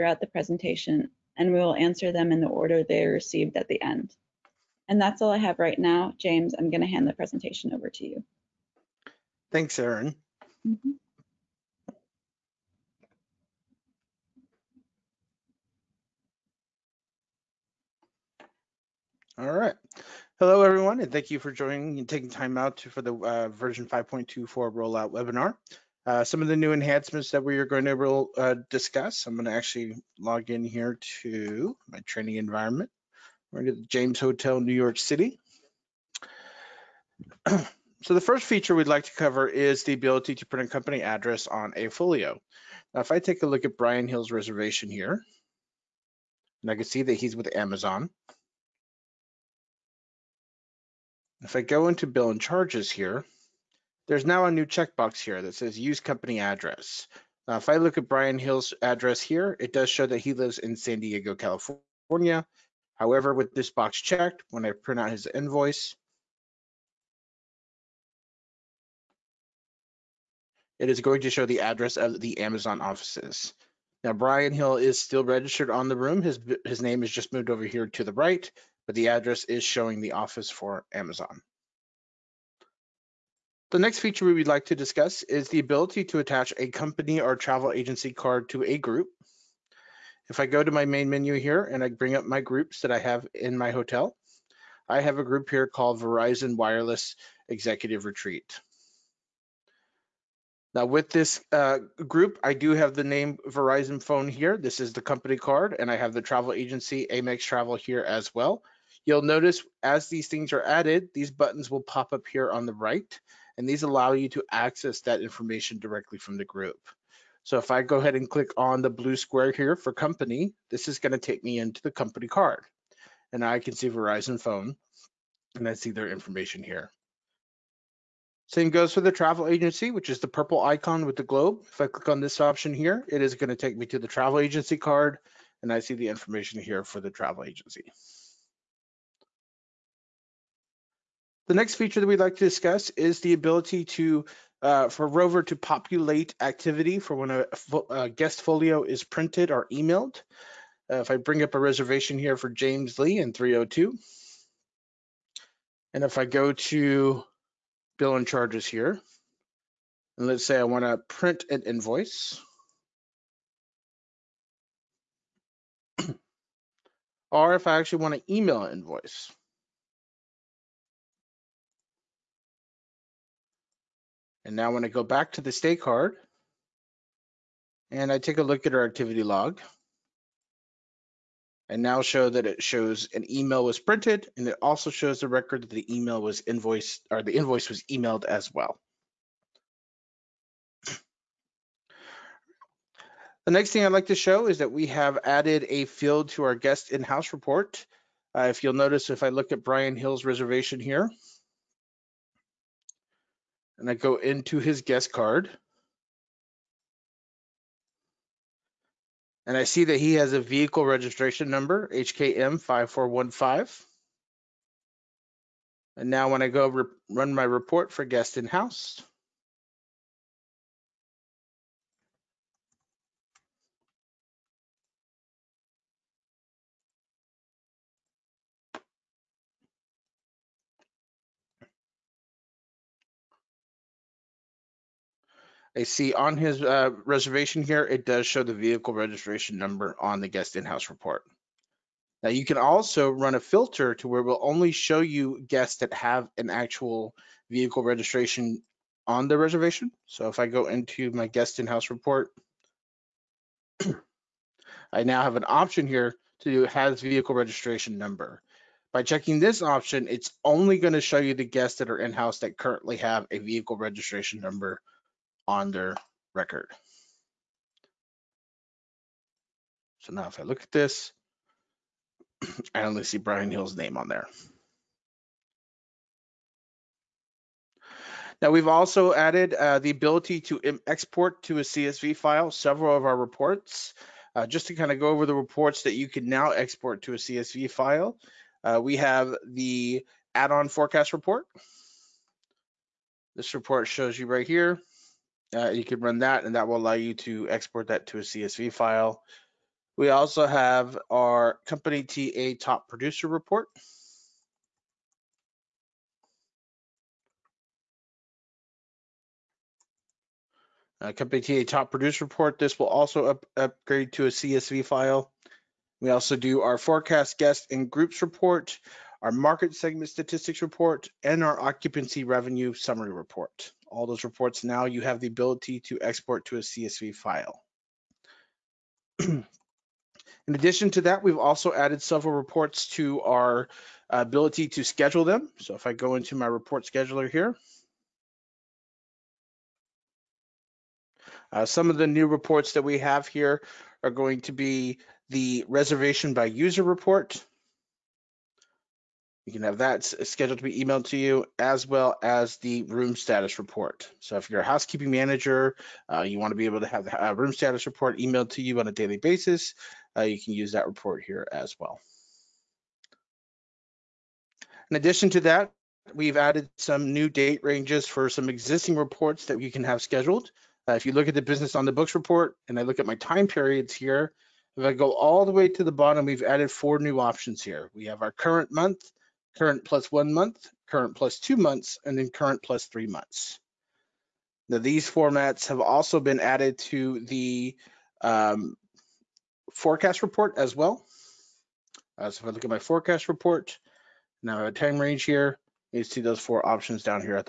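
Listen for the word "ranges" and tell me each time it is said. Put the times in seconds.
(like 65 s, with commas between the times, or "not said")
367 s, 394 s.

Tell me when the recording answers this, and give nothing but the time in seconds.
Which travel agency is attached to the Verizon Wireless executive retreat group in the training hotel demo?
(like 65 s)
107 s.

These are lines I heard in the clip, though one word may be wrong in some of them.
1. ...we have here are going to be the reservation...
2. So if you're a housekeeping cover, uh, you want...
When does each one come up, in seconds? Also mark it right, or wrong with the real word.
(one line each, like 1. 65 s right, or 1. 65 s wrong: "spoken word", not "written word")
1. 342 s right
2. 354 s wrong: "manager", not "cover".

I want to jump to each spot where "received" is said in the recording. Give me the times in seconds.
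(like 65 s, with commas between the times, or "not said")
3 s.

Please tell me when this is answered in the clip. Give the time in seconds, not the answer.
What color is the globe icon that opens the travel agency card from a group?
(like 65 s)
130 s.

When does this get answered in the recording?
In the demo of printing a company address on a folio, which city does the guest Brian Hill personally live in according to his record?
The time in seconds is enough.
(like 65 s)
60 s.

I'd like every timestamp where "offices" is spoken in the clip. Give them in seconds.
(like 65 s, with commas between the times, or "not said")
72 s, 80 s.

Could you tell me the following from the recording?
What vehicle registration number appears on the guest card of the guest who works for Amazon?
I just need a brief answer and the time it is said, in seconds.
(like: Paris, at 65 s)
HKM 5415, at 211 s.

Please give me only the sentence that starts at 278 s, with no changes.
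Now we've also added uh, the ability to export to a CSV file several of our reports.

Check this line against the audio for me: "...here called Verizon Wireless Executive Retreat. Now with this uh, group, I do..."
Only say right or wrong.
right.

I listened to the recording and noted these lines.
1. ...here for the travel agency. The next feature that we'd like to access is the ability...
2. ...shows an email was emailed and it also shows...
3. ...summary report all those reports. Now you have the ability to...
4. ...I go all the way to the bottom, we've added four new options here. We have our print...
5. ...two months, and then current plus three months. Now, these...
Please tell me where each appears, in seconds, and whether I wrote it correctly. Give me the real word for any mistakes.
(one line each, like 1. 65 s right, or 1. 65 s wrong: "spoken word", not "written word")
1. 136 s wrong: "discuss", not "access"
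2. 182 s wrong: "printed", not "emailed"
3. 322 s right
4. 374 s wrong: "current", not "print"
5. 381 s right.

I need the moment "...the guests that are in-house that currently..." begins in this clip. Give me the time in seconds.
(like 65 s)
261 s.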